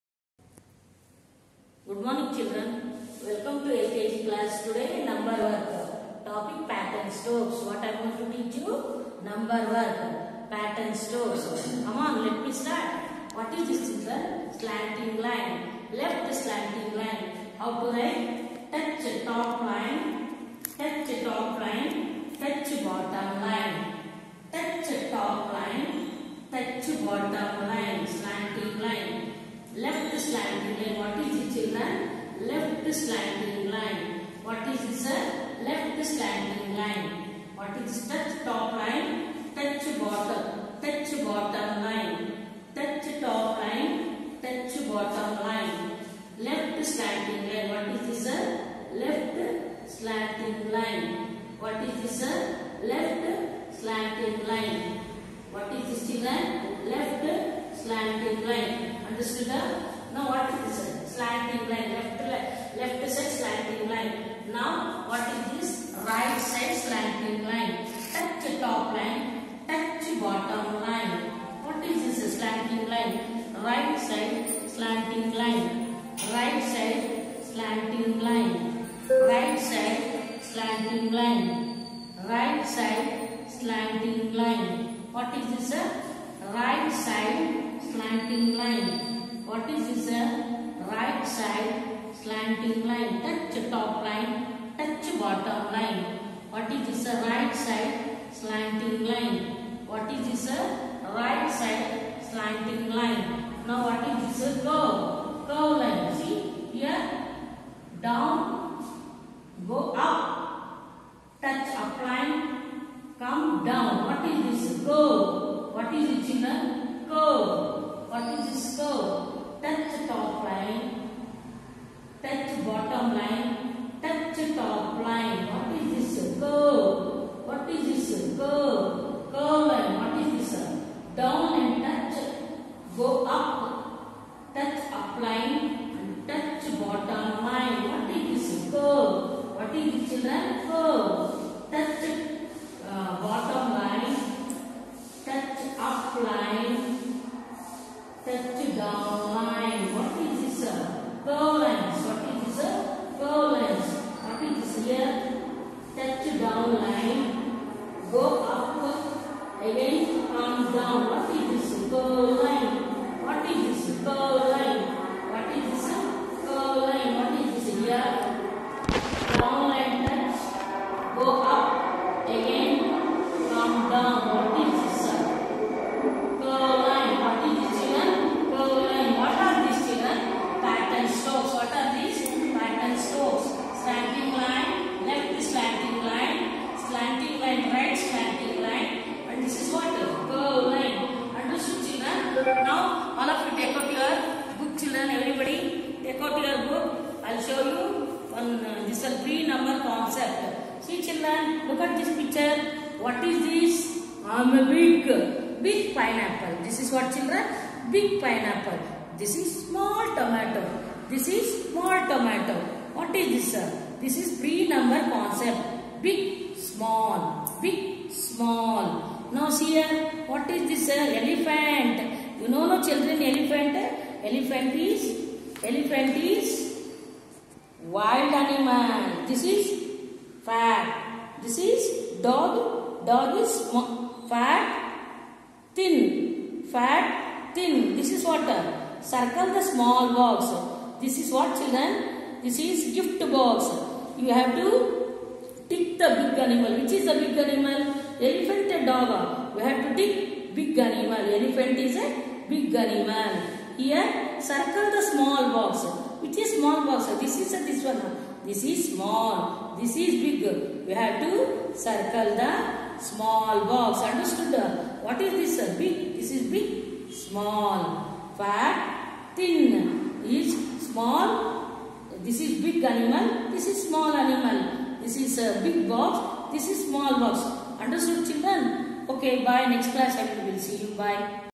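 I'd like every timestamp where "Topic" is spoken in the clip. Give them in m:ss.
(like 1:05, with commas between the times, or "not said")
0:06.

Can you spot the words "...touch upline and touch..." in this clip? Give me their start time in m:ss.
2:14.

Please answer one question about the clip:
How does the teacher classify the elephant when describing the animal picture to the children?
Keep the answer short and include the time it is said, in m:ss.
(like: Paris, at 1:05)
Wild animal, at 3:47.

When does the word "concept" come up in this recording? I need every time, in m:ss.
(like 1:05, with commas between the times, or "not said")
3:35.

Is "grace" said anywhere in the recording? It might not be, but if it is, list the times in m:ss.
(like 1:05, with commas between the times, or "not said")
not said.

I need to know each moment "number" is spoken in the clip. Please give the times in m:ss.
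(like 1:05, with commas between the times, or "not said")
0:05, 0:09, 3:34.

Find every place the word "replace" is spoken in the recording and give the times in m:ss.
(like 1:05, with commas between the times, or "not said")
not said.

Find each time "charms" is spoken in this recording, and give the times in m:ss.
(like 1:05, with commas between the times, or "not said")
not said.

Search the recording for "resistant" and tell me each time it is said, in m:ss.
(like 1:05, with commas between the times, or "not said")
not said.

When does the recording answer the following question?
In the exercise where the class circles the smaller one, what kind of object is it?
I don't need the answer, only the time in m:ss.
4:02.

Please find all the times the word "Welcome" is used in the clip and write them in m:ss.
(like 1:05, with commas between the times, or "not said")
0:03.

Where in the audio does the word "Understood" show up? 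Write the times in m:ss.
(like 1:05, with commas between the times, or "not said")
0:59, 4:24, 4:37.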